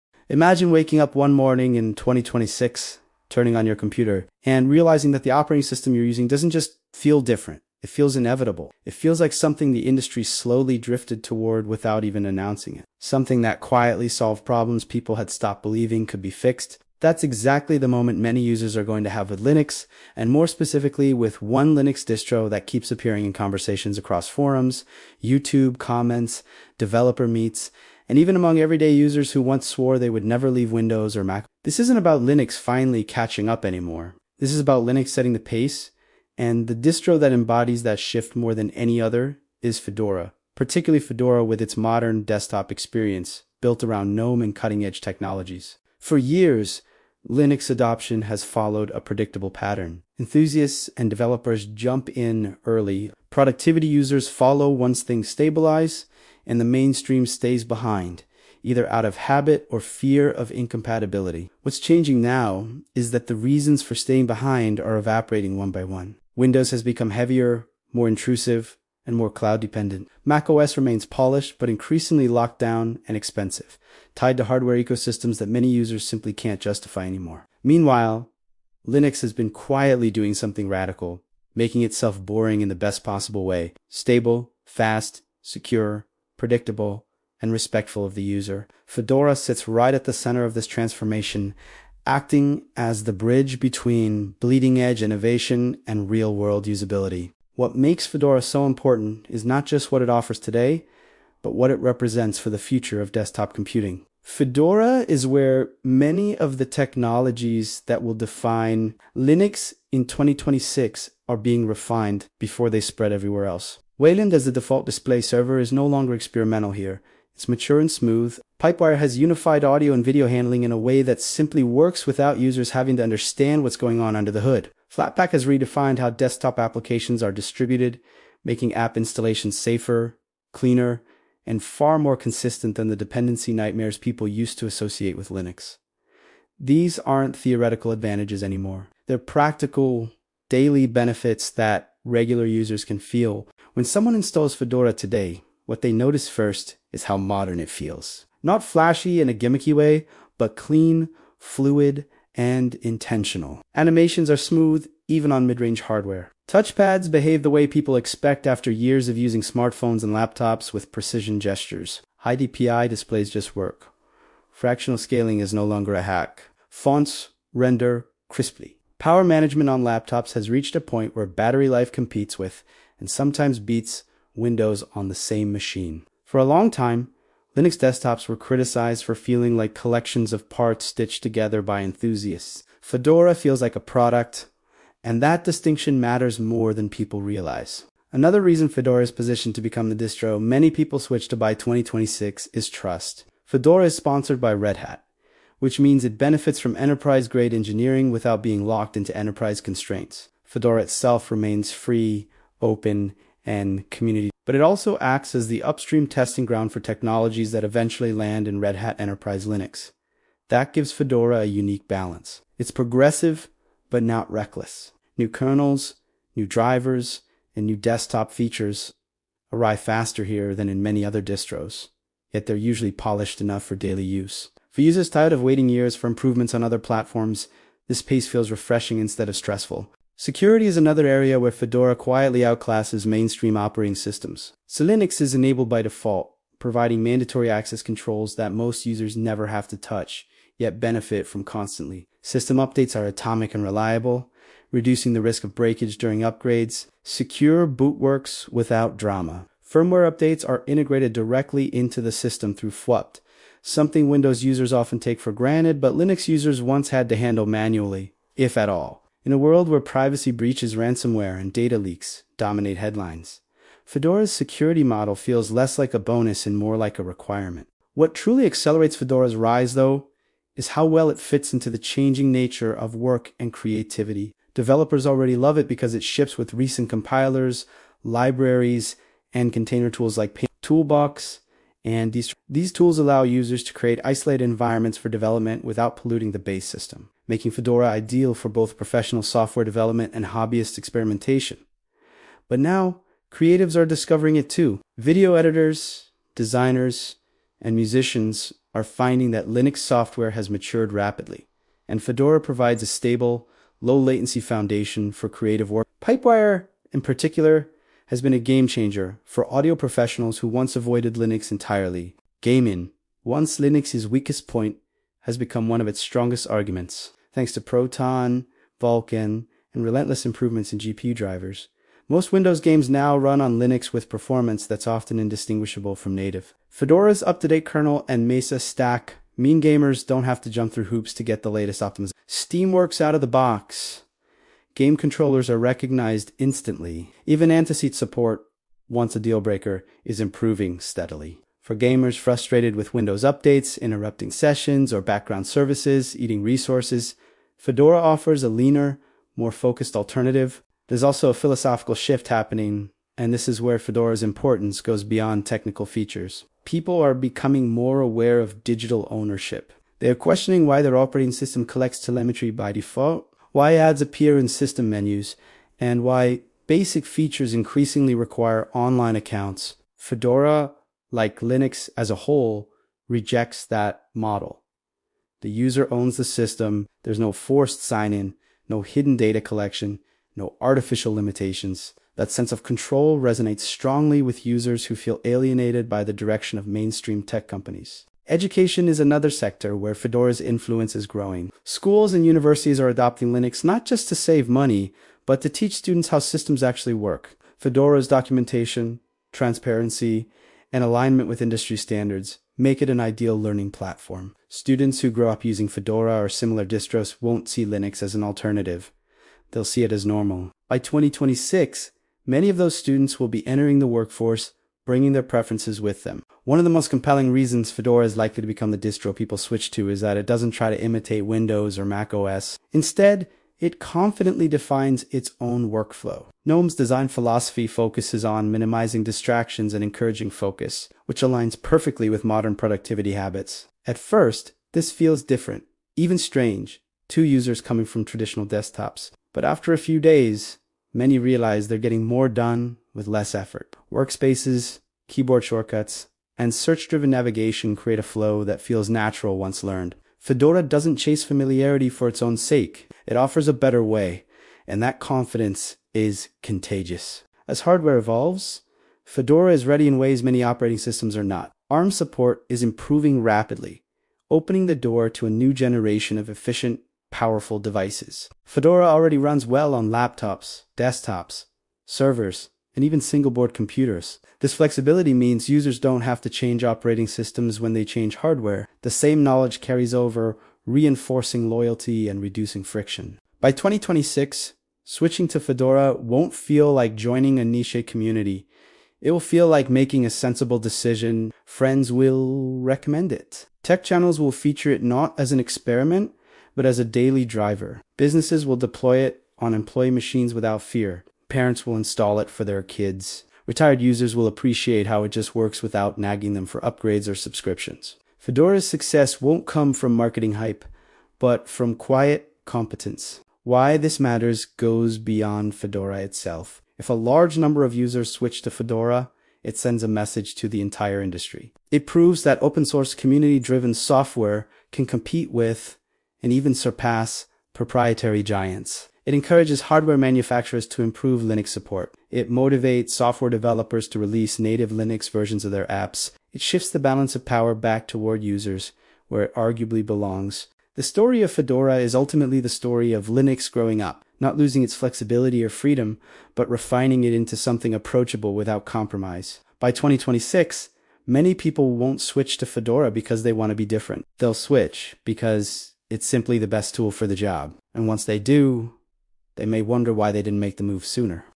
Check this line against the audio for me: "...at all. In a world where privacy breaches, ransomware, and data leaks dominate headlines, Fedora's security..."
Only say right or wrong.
right.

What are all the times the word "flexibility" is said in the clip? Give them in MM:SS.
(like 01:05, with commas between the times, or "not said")
07:54, 09:04.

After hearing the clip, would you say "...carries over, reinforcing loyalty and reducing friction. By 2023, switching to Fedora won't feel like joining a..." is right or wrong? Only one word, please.
wrong.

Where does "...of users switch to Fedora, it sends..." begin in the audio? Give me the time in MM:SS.
08:37.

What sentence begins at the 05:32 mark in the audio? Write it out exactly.
Steam works out of the box.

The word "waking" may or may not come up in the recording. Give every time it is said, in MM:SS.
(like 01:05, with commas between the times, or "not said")
00:00.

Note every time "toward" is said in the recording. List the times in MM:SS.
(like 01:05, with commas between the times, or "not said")
00:11, 08:57.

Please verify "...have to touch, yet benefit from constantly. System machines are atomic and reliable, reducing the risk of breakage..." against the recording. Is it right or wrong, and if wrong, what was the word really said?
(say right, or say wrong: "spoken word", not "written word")
wrong: "updates", not "machines".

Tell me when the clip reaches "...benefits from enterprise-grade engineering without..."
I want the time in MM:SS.
03:16.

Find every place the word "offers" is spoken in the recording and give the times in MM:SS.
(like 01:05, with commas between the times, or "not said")
01:40, 05:47, 07:33.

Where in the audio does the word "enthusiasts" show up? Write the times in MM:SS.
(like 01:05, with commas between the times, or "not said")
00:50, 03:01.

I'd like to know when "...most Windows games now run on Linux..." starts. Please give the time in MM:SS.
05:22.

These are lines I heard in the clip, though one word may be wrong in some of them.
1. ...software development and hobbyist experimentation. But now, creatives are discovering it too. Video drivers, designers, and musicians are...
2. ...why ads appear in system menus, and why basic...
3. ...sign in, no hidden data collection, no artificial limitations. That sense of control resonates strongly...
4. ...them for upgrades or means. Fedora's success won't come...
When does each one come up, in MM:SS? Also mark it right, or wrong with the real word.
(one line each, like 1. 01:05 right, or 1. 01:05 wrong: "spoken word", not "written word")
1. 04:49 wrong: "editors", not "drivers"
2. 06:03 right
3. 06:17 right
4. 08:26 wrong: "subscriptions", not "means".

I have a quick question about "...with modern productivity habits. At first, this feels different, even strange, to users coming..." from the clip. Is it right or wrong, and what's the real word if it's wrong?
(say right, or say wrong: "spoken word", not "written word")
right.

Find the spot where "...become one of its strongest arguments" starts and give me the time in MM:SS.
05:15.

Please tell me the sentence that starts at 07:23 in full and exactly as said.
Workspaces, keyboard shortcuts, and search-driven navigation create a flow that feels natural once learned.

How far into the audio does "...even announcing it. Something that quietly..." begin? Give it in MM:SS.
00:12.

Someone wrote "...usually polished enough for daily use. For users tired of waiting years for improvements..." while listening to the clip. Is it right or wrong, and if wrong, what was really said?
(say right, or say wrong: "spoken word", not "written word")
right.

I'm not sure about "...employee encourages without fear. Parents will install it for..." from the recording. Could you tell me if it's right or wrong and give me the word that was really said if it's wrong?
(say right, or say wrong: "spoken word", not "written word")
wrong: "machines", not "encourages".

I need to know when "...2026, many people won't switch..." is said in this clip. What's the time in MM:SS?
09:09.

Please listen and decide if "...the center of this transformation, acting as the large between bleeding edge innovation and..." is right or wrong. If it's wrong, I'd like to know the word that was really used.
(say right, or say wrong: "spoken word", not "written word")
wrong: "bridge", not "large".